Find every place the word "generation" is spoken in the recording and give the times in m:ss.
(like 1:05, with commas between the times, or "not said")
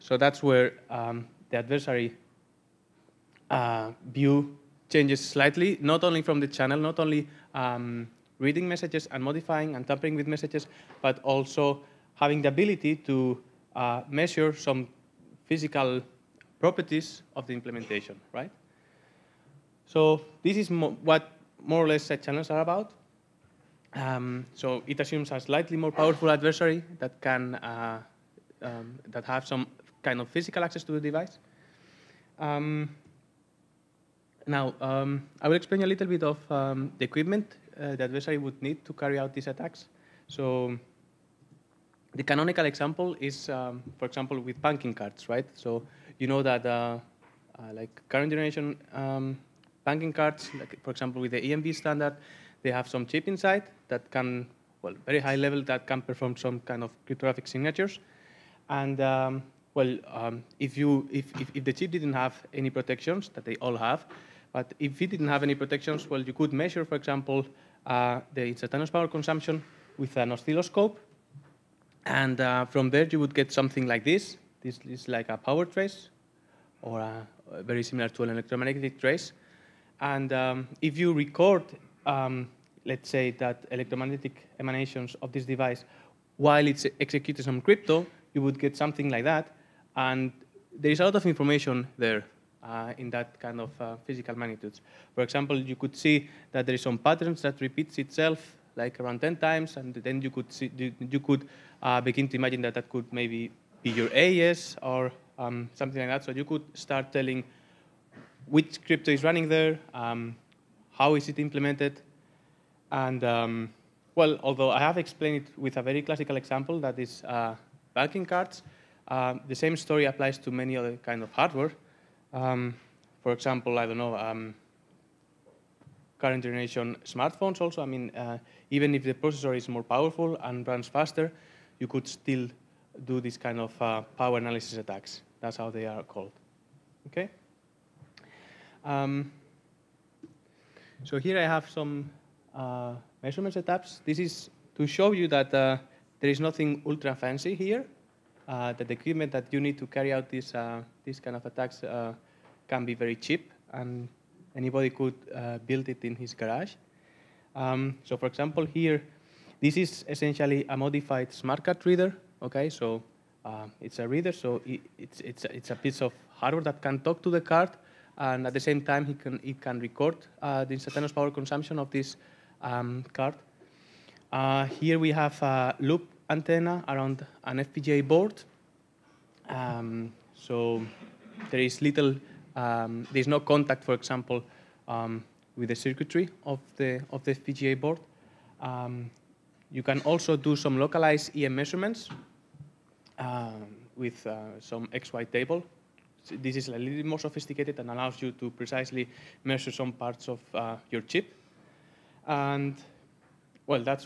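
0:48, 2:06.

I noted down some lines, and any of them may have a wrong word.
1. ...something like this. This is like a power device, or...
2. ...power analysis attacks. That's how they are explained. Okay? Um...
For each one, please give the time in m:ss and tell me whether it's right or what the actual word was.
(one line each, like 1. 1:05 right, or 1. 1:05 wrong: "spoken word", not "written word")
1. 1:13 wrong: "trace", not "device"
2. 2:14 wrong: "called", not "explained".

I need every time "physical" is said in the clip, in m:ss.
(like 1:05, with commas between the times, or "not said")
0:15, 0:30, 1:34.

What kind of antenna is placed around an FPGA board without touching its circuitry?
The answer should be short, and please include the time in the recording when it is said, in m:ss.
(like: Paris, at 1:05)
Loop antenna, at 2:55.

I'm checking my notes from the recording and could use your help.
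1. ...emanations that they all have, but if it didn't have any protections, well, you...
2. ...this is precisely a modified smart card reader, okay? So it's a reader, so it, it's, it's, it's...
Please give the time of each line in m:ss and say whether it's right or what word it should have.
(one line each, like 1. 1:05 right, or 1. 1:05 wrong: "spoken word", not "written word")
1. 1:02 wrong: "protections", not "emanations"
2. 2:39 wrong: "essentially", not "precisely".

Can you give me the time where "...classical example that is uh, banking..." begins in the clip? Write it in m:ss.
1:56.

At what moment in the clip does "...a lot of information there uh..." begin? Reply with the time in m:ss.
1:30.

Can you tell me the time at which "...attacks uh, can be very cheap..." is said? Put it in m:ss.
2:31.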